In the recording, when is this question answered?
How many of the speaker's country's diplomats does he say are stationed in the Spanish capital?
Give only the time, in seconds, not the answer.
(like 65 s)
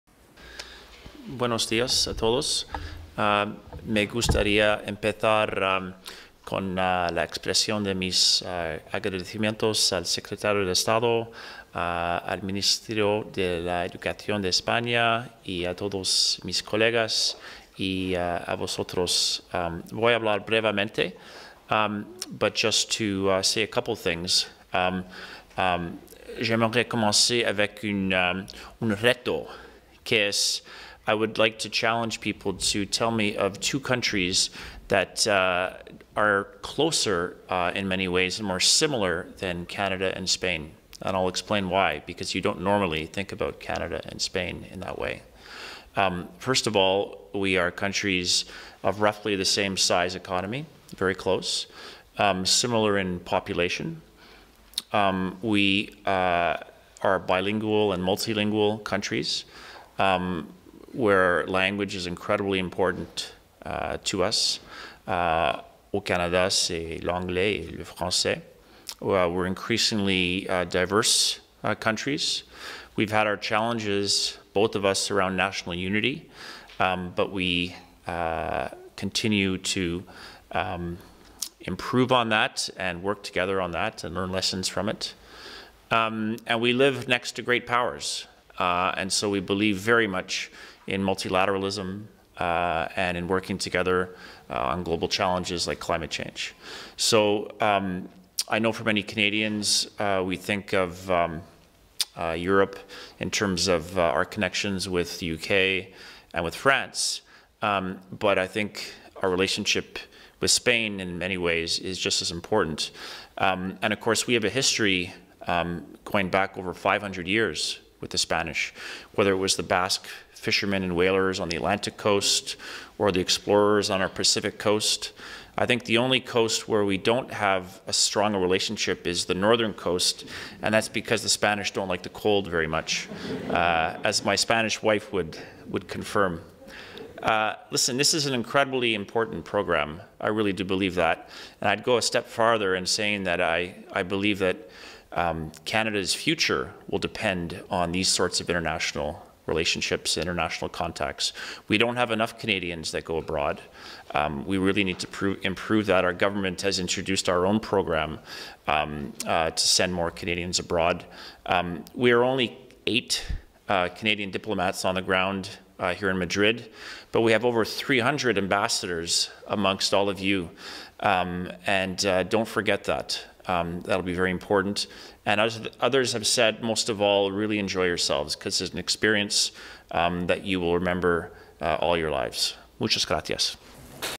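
162 s.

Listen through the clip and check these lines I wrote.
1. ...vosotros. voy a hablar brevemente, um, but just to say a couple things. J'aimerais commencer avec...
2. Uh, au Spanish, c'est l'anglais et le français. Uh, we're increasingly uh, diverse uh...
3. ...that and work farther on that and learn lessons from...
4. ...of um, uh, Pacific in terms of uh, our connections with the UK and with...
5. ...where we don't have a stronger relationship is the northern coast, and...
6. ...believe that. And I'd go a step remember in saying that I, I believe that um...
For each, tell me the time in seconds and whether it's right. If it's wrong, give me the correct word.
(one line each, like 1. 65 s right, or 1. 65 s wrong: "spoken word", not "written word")
1. 18 s right
2. 65 s wrong: "Canada", not "Spanish"
3. 82 s wrong: "together", not "farther"
4. 100 s wrong: "Europe", not "Pacific"
5. 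126 s right
6. 140 s wrong: "farther", not "remember".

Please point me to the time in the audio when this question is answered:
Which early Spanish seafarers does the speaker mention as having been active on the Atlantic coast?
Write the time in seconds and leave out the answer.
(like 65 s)
119 s.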